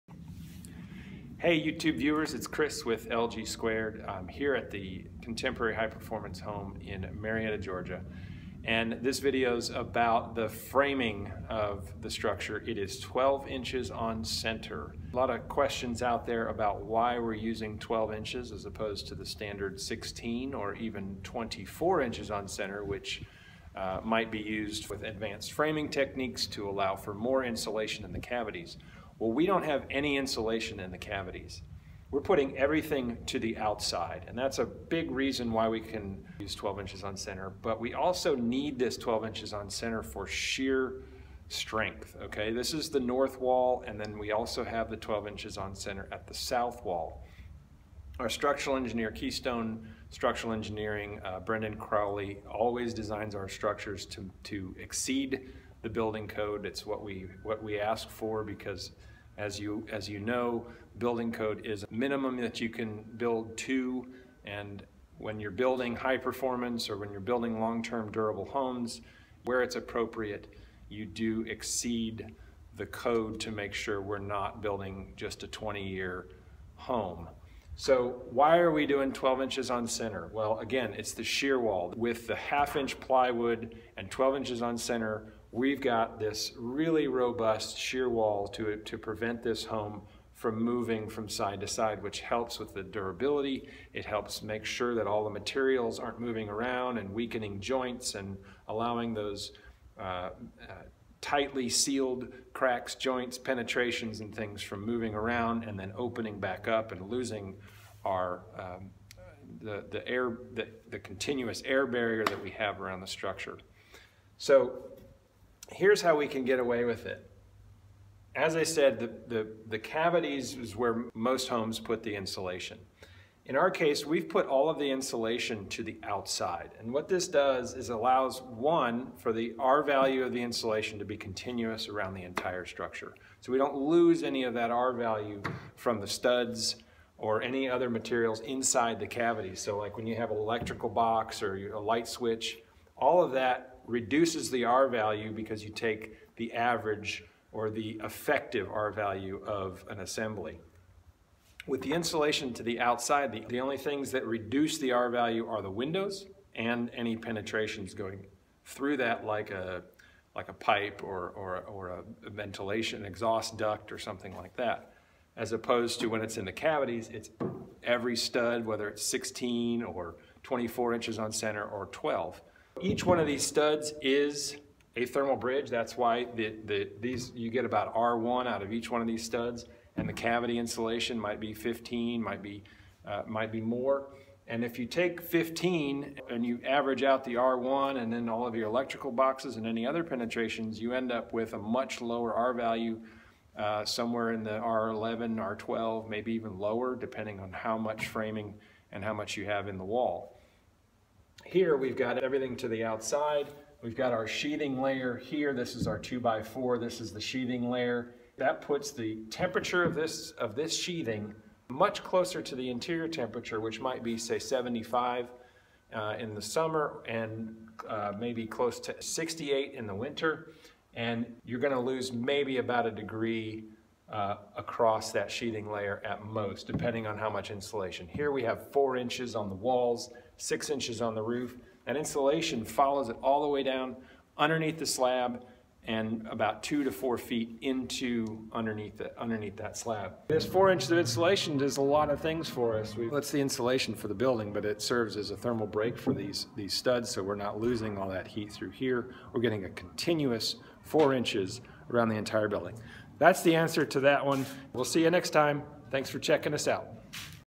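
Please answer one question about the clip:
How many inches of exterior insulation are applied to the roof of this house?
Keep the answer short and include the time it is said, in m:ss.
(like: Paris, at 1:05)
6 inches, at 3:50.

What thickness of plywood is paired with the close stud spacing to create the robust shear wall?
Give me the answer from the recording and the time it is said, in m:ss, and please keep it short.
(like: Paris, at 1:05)
1/2 inch, at 1:22.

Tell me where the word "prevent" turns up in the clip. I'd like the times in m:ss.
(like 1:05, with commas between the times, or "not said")
1:28.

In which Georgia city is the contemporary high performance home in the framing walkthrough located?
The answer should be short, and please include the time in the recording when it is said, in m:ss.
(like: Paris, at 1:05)
Marietta, at 0:07.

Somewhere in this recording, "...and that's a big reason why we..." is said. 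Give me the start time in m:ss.
0:34.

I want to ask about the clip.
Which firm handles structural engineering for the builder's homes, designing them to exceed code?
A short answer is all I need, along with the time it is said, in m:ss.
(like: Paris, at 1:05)
Keystone Structural Engineering, at 0:49.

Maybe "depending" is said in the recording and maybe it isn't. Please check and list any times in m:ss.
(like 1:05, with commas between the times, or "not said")
3:16, 3:46.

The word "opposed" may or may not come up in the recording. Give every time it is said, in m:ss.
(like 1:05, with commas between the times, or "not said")
0:18, 2:45.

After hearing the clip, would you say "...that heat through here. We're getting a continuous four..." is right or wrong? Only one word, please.
right.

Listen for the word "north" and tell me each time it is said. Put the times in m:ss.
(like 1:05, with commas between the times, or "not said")
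0:42.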